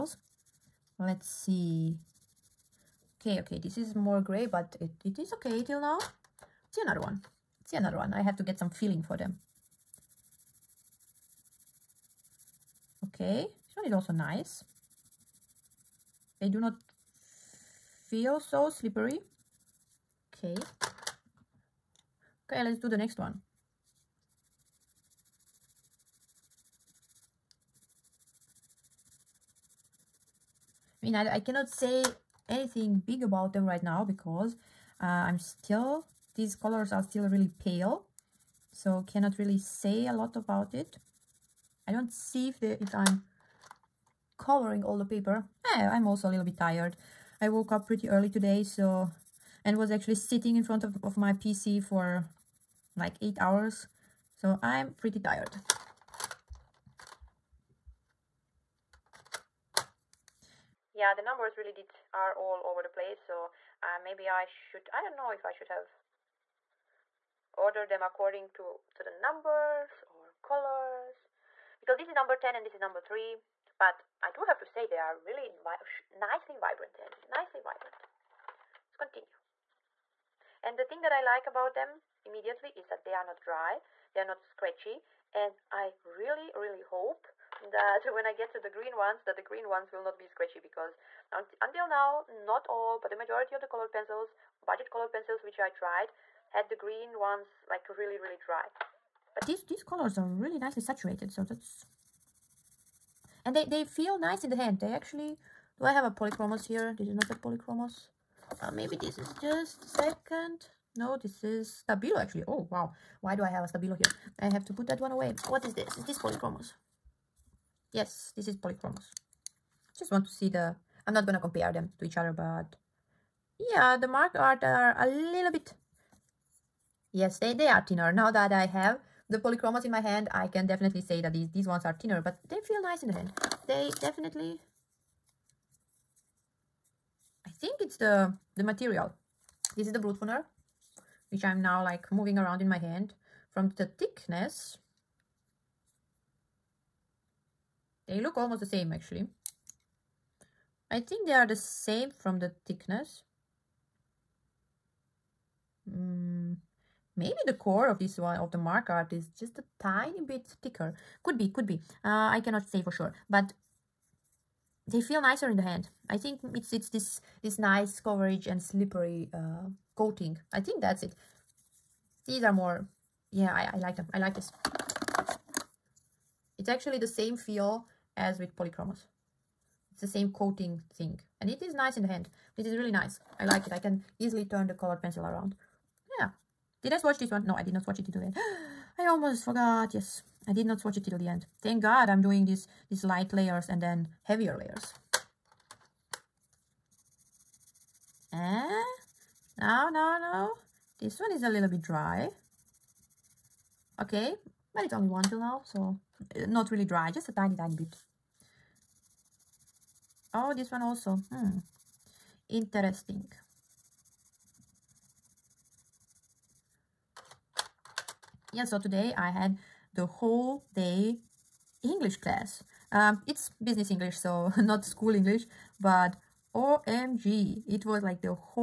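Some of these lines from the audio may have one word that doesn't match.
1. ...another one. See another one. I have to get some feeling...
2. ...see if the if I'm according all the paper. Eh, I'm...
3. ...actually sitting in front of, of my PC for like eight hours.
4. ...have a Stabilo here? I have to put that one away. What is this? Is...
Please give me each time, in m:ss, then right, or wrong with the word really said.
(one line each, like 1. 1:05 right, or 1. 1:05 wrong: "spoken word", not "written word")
1. 0:06 right
2. 0:42 wrong: "covering", not "according"
3. 0:49 right
4. 1:53 right.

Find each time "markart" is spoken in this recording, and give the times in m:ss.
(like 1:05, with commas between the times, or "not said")
2:04, 2:38.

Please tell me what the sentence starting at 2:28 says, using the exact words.
They look almost the same actually.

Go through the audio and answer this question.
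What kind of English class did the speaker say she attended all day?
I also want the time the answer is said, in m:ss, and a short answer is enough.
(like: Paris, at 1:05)
Business English, at 3:43.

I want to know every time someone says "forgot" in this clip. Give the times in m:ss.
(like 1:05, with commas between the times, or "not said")
3:09.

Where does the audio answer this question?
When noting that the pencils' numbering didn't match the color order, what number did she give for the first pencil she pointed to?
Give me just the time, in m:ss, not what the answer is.
1:12.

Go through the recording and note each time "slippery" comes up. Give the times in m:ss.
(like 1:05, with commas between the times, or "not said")
0:18, 2:48.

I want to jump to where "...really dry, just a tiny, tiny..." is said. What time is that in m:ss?
3:26.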